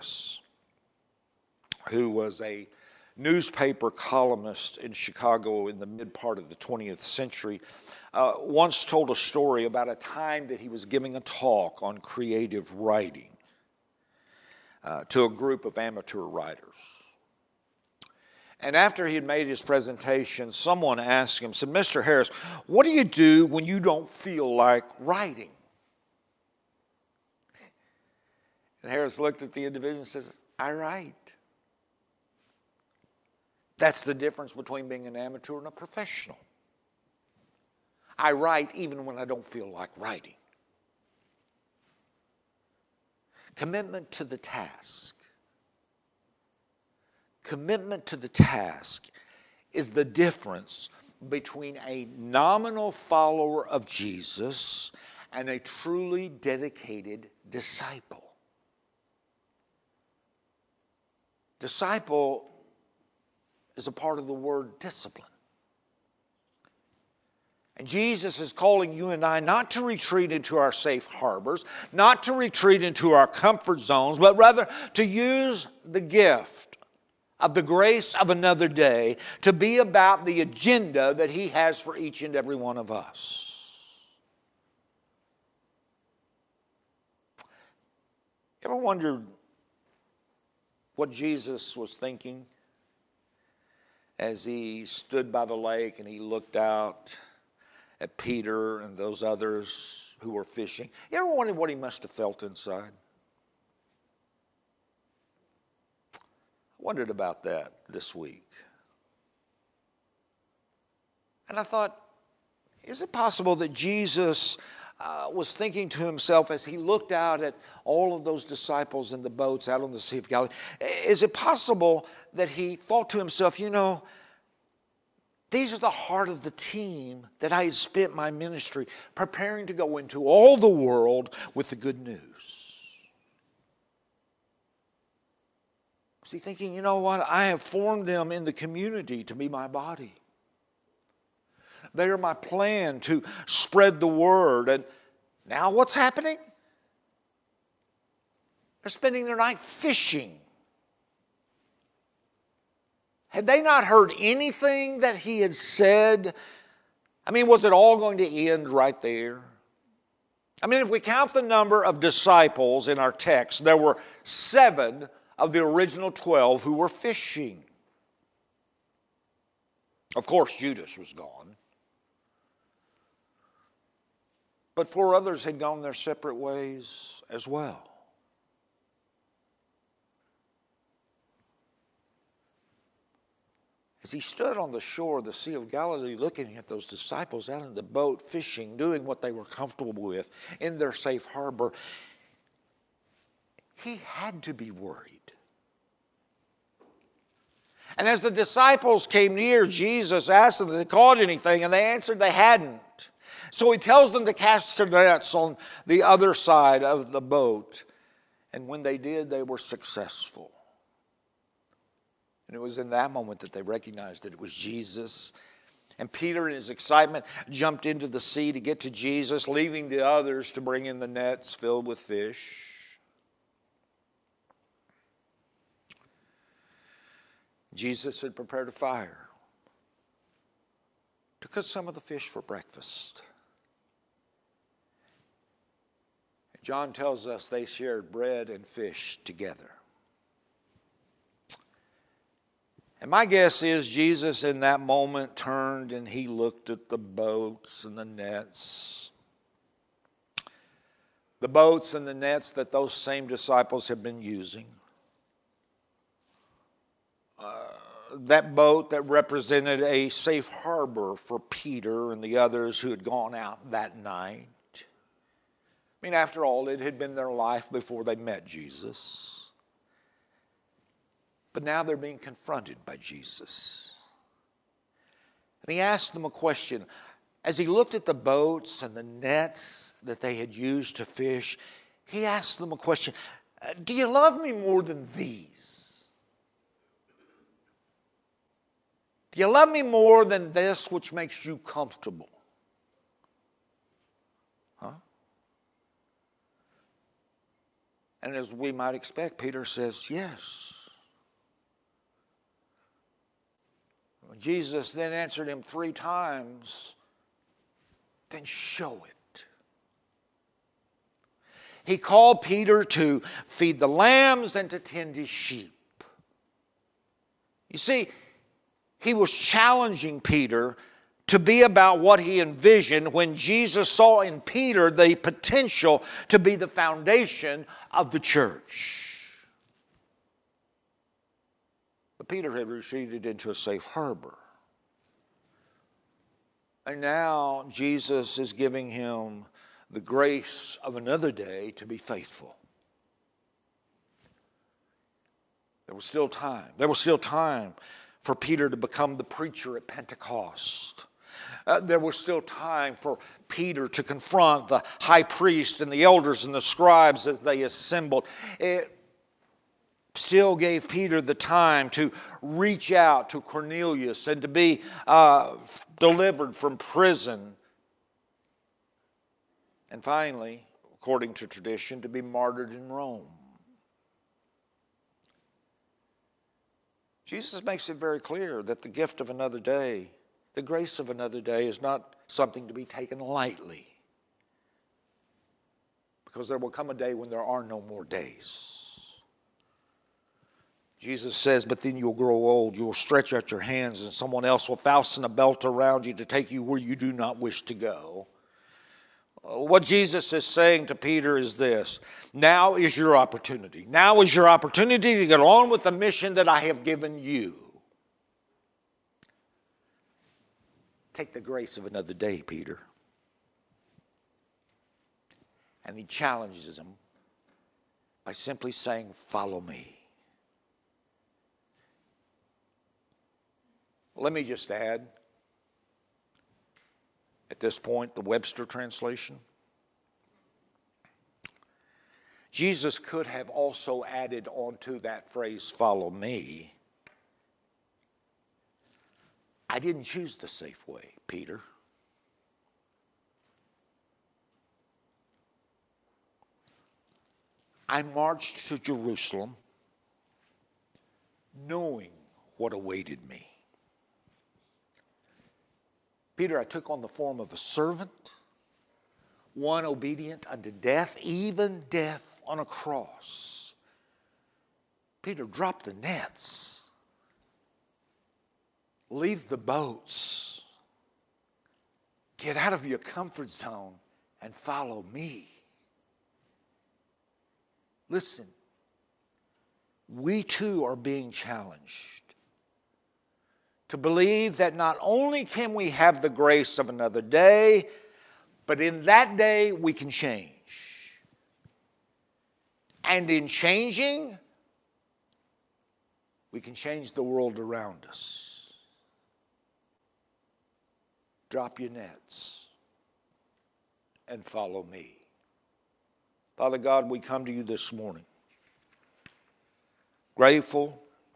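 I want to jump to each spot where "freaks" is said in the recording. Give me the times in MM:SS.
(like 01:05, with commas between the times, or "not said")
not said.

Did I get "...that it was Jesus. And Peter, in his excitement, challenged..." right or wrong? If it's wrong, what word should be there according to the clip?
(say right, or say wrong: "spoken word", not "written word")
wrong: "jumped", not "challenged".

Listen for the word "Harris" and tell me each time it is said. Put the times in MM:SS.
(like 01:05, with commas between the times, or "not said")
00:22, 00:28.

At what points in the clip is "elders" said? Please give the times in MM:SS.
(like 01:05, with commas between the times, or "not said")
05:56.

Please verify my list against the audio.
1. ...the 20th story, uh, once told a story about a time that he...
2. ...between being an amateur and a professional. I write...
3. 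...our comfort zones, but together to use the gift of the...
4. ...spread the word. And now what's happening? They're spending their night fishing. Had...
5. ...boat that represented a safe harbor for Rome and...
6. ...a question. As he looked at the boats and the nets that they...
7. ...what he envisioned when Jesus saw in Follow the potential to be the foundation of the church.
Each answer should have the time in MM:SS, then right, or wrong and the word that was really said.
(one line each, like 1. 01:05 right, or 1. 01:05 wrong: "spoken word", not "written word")
1. 00:06 wrong: "century", not "story"
2. 00:34 right
3. 01:13 wrong: "rather", not "together"
4. 02:23 right
5. 04:18 wrong: "Peter", not "Rome"
6. 04:36 right
7. 05:21 wrong: "Peter", not "Follow".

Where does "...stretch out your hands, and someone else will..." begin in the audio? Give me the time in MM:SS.
06:32.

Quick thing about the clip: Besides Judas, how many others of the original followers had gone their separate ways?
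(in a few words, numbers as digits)
4.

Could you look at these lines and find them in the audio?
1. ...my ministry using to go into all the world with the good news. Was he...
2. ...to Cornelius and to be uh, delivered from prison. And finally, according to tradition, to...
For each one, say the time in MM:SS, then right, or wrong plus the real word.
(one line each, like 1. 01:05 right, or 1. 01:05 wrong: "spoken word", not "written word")
1. 02:08 wrong: "preparing", not "using"
2. 06:03 right.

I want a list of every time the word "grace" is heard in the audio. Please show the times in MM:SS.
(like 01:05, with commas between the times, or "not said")
01:17, 05:40, 06:20, 06:51, 08:06.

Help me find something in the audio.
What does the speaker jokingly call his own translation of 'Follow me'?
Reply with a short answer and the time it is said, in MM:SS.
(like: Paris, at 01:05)
The Webster translation, at 07:08.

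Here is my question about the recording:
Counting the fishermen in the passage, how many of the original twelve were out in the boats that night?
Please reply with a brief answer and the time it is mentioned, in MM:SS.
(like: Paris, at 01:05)
7, at 02:44.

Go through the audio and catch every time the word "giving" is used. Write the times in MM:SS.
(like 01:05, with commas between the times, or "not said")
00:10, 05:38.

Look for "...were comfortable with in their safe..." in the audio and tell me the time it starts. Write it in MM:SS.
03:09.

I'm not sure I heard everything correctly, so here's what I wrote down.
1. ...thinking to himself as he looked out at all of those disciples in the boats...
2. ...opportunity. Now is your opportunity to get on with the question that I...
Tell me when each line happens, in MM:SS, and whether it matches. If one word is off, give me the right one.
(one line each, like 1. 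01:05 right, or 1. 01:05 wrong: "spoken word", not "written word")
1. 01:55 right
2. 06:43 wrong: "mission", not "question".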